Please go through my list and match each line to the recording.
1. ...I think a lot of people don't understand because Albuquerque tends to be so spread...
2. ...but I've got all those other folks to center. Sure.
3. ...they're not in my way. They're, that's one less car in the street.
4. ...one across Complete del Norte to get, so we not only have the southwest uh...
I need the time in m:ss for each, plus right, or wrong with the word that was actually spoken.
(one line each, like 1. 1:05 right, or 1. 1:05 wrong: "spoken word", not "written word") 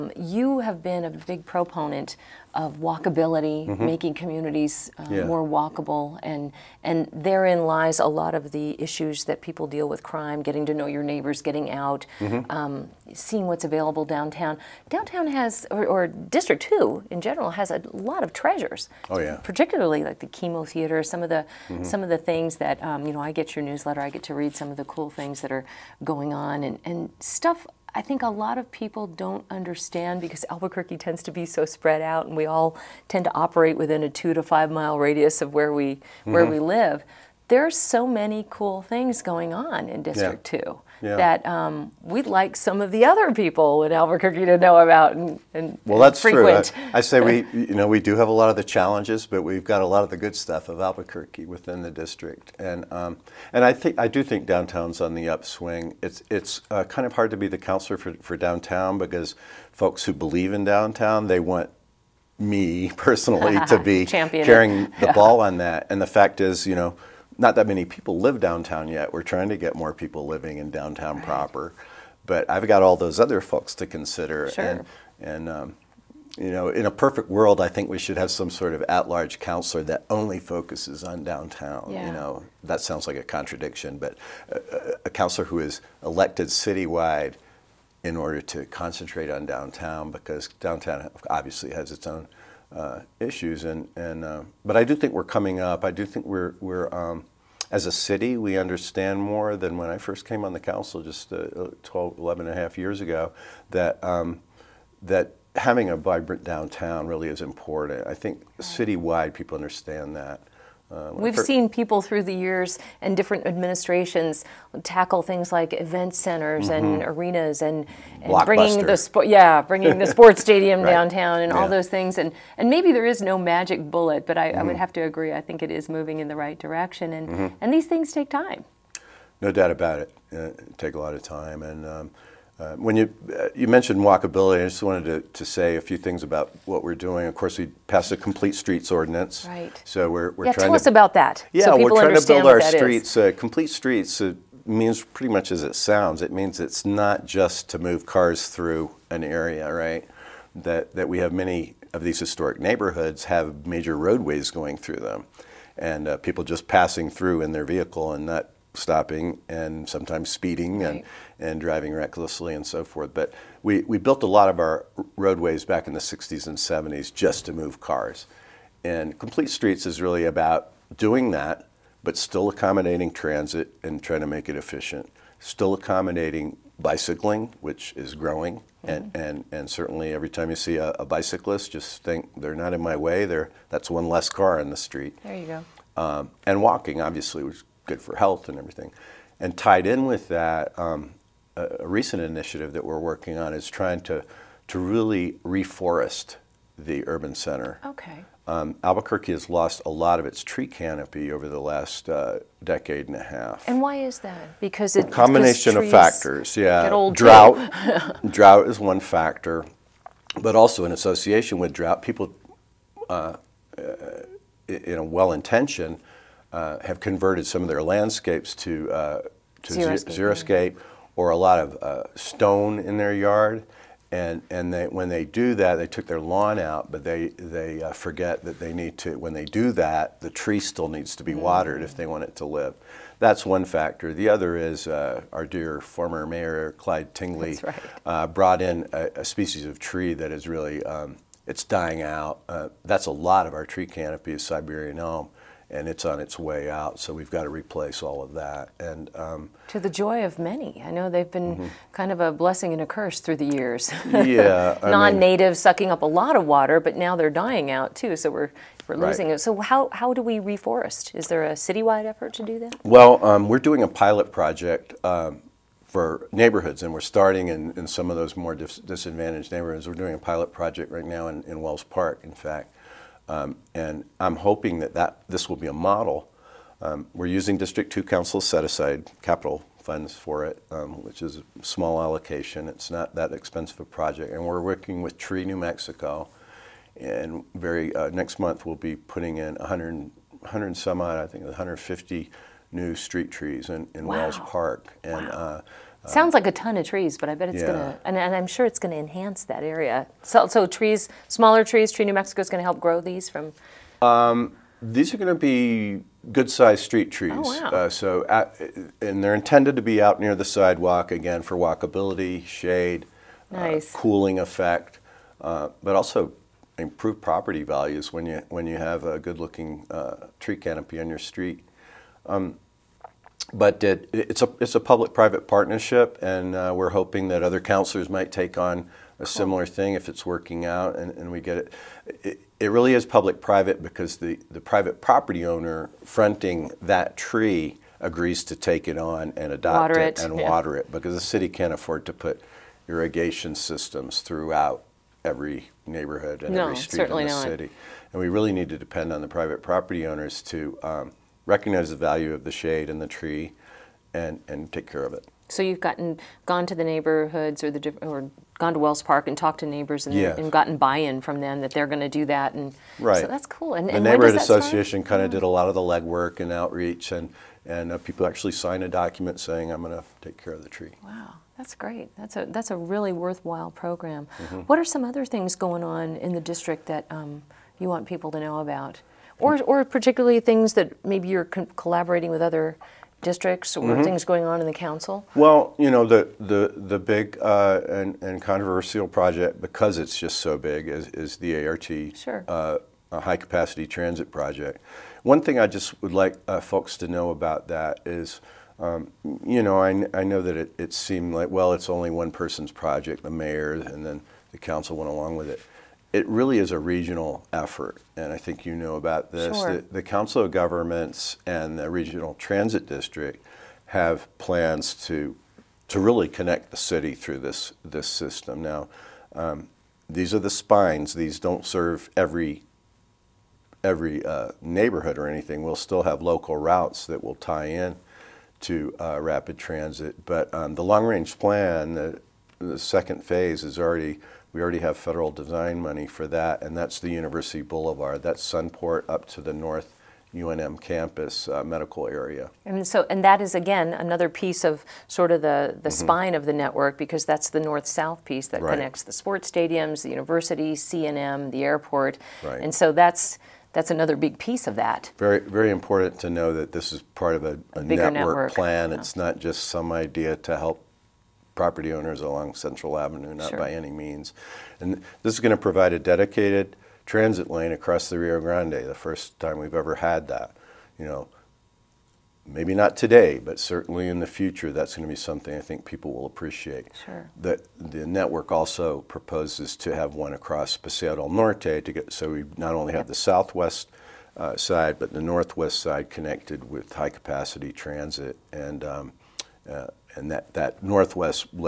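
1. 0:27 right
2. 1:12 wrong: "consider", not "center"
3. 3:02 right
4. 8:00 wrong: "Paseo", not "Complete".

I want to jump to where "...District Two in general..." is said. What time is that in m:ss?
0:16.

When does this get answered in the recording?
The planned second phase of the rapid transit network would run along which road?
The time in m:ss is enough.
7:17.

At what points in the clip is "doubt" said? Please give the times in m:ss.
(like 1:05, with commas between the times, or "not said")
2:09.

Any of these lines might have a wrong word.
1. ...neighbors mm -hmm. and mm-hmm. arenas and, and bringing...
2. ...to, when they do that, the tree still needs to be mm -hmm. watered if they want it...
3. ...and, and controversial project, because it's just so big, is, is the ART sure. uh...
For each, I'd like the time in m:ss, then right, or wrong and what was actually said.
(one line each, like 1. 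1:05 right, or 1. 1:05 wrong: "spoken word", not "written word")
1. 1:56 wrong: "centers", not "neighbors"
2. 3:48 right
3. 6:27 right.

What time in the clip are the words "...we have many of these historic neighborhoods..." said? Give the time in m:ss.
2:31.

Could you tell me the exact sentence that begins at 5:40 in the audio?
water it because the city can't afford to put irrigation systems throughout every neighborhood and no, every street in the not.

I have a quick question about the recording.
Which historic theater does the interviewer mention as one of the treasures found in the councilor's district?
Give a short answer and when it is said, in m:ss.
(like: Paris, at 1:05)
KiMo theater, at 0:20.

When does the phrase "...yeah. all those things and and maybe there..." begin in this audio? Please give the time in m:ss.
2:01.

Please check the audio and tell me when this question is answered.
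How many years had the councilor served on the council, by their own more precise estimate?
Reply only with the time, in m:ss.
1:42.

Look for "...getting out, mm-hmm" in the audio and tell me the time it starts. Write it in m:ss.
0:11.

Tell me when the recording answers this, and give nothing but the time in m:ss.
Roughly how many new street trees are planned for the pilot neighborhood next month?
4:51.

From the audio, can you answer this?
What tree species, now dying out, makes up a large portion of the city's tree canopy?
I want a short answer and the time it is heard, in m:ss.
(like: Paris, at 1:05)
Siberian elm, at 4:04.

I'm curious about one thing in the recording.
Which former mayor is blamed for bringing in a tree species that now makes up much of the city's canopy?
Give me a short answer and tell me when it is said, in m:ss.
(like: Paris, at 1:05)
Clyde Tingley, at 3:56.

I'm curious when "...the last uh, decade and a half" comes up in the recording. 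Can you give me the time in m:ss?
3:21.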